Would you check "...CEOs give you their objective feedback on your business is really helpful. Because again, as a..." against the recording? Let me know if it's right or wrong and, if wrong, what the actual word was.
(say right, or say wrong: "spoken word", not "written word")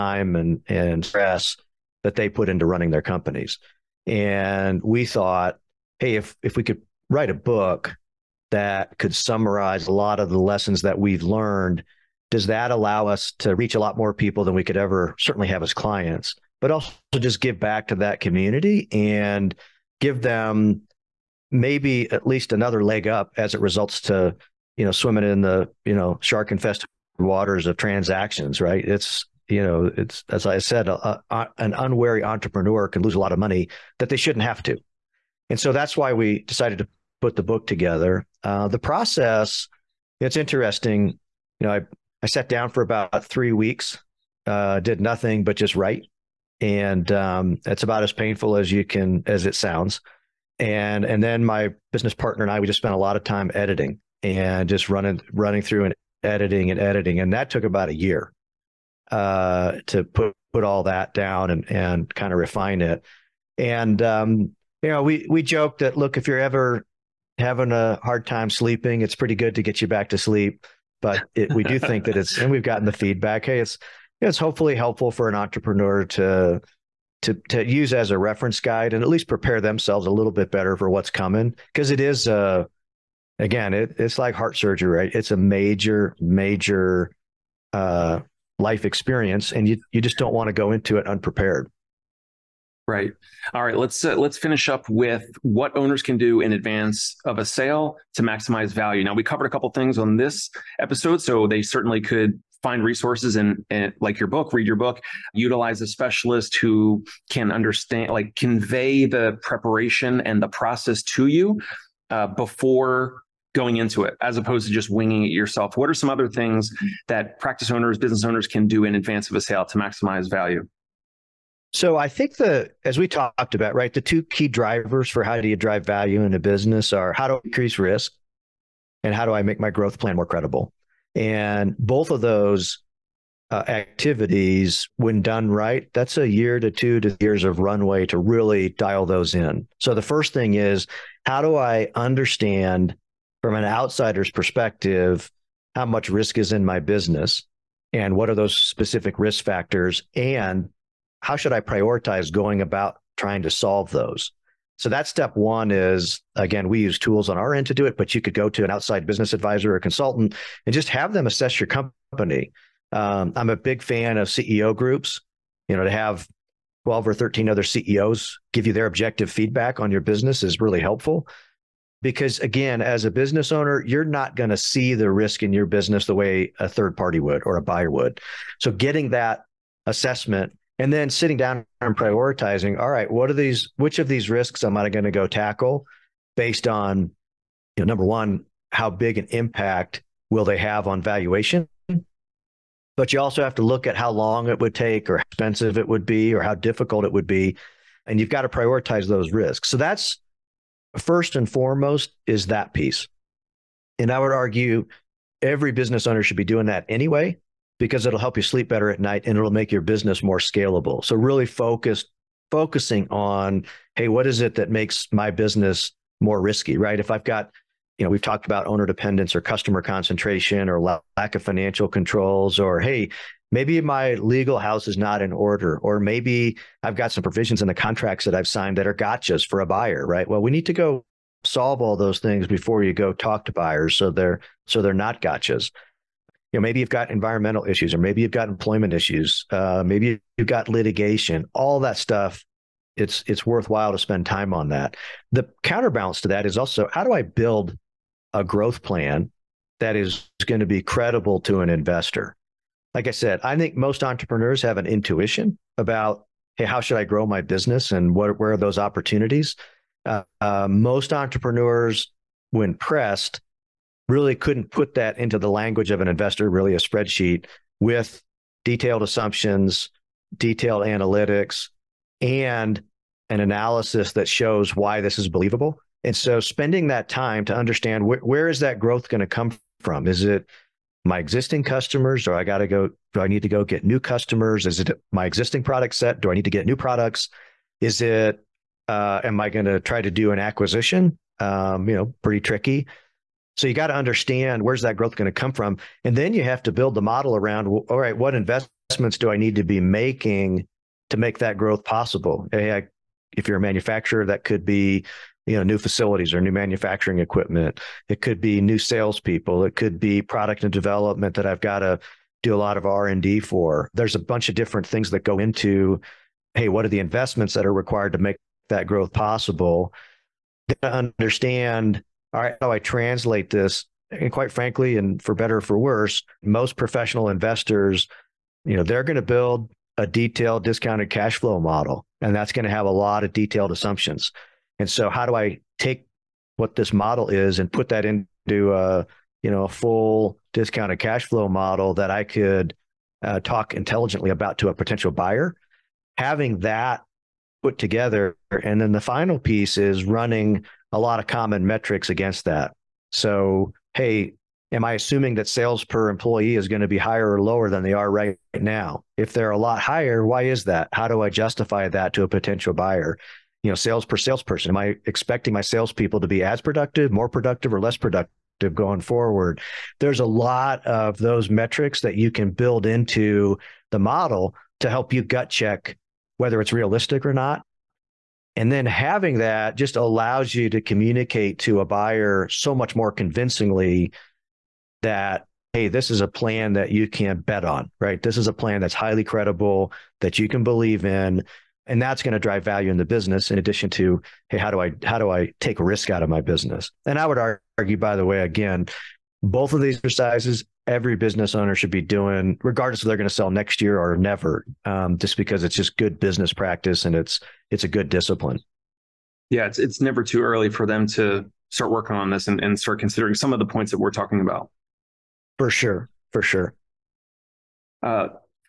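right.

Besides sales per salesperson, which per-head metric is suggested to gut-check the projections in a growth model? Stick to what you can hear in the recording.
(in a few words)
sales per employee.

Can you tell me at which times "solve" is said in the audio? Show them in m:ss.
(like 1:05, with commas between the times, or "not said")
2:33, 3:51.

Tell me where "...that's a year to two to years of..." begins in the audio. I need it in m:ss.
2:15.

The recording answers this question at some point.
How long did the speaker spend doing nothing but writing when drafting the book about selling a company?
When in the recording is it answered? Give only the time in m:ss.
0:43.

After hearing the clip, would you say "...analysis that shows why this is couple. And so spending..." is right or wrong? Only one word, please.
wrong.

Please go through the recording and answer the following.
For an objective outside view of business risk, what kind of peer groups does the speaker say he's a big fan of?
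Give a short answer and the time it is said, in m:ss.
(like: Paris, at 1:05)
CEO groups, at 2:44.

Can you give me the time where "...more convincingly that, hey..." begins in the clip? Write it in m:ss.
6:22.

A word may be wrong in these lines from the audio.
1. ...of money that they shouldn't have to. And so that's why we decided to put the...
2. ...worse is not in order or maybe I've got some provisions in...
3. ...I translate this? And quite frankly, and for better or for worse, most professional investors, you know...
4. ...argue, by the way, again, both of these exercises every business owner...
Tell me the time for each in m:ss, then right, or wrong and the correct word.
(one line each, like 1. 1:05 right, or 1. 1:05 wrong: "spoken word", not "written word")
1. 0:33 right
2. 3:44 wrong: "house", not "worse"
3. 5:22 right
4. 6:37 right.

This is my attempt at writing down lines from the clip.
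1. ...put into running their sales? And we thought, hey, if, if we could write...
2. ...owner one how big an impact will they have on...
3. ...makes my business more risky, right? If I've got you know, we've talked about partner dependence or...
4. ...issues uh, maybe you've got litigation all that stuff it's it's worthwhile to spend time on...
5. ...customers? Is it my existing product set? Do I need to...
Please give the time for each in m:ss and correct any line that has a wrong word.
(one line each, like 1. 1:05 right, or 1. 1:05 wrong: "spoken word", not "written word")
1. 0:02 wrong: "companies", not "sales"
2. 3:07 wrong: "number", not "owner"
3. 3:34 wrong: "owner", not "partner"
4. 3:58 right
5. 4:43 right.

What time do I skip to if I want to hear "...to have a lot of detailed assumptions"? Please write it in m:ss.
5:32.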